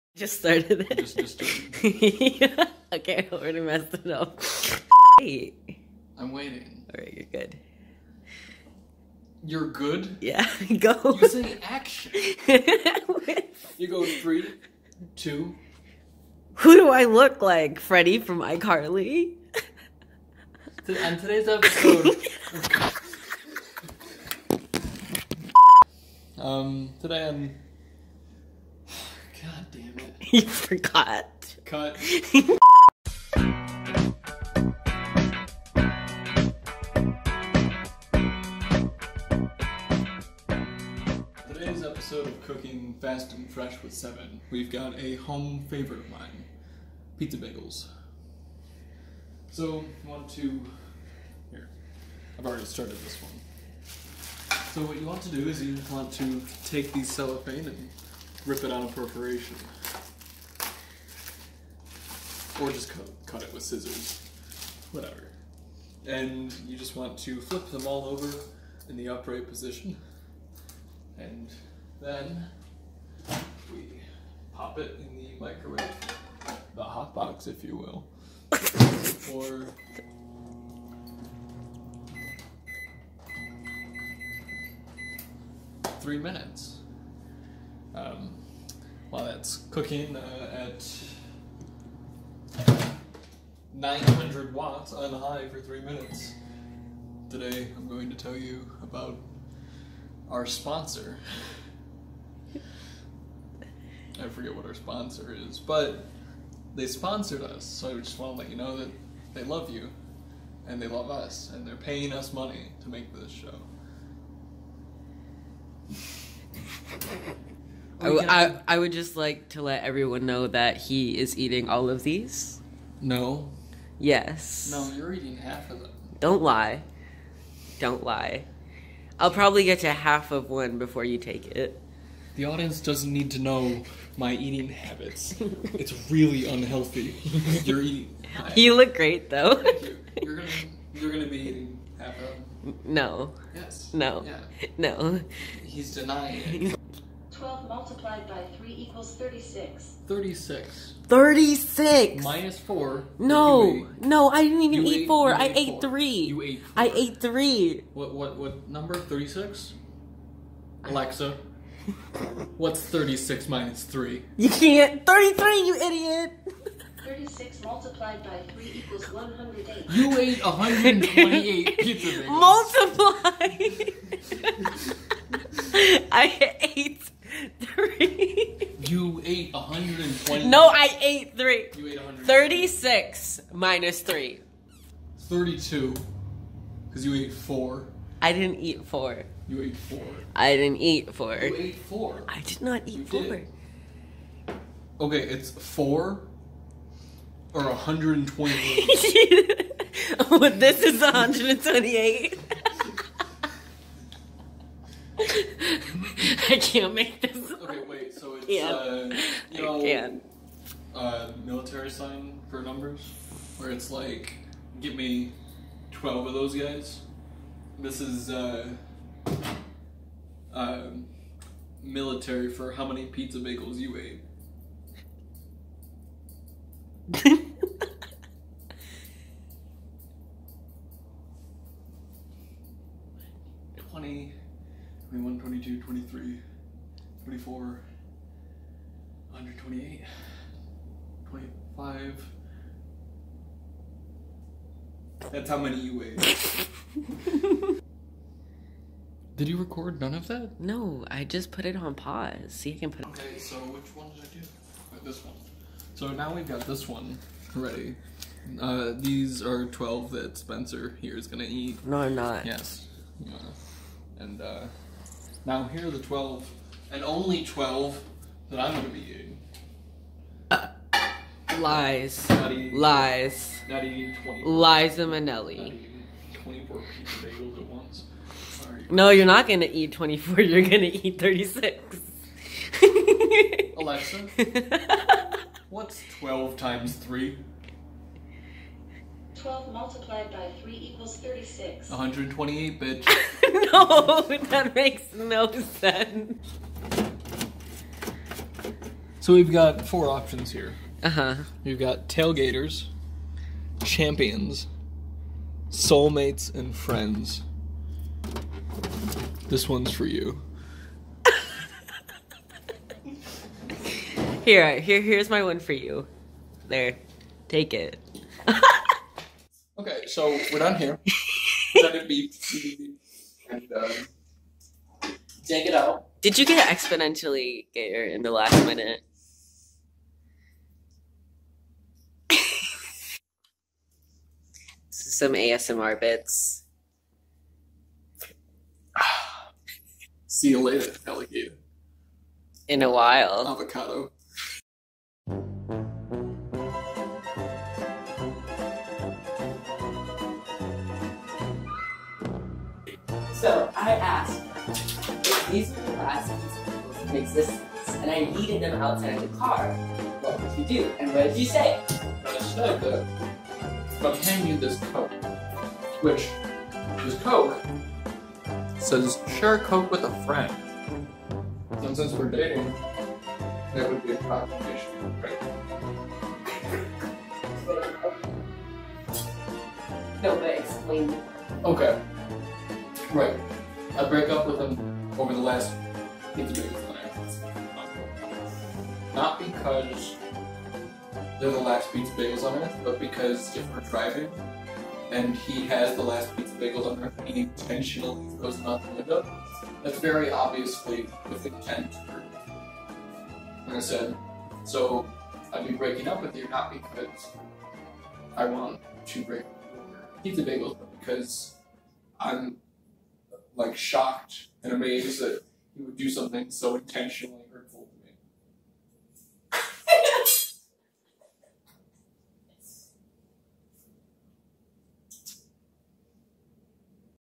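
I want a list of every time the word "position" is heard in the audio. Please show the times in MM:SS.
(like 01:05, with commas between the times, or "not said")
01:09.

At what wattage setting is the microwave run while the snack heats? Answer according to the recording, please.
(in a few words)
900 watts.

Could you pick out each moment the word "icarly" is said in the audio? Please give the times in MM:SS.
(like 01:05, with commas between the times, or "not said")
00:18.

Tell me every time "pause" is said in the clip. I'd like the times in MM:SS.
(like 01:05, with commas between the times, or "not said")
04:11.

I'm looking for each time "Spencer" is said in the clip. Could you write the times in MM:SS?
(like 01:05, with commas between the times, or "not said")
04:20.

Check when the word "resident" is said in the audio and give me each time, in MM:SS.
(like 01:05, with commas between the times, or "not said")
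not said.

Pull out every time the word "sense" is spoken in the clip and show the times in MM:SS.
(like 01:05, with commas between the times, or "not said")
04:55.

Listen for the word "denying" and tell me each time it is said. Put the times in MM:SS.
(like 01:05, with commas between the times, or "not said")
02:25.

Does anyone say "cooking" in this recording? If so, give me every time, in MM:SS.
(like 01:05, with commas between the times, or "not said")
00:42, 01:29.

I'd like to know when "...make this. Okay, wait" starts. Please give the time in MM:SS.
03:26.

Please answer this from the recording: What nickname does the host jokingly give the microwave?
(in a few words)
The hot box.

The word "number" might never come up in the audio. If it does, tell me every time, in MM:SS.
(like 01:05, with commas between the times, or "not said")
02:38, 03:32.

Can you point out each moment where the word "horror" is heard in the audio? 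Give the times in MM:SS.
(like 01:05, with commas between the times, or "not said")
not said.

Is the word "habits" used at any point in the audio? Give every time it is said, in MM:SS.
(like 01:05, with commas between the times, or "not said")
02:14.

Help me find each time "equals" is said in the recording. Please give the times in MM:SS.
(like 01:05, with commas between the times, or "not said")
02:48, 04:50.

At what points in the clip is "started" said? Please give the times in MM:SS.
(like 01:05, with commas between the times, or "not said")
00:00, 00:52.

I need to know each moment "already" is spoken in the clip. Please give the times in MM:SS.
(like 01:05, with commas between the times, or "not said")
00:03, 00:52.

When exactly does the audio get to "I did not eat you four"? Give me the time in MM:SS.
03:12.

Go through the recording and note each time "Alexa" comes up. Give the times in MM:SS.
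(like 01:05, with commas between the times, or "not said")
02:40, 04:43.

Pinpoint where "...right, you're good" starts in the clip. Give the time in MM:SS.
00:07.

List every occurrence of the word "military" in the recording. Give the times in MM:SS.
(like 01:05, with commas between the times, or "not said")
03:31, 03:41.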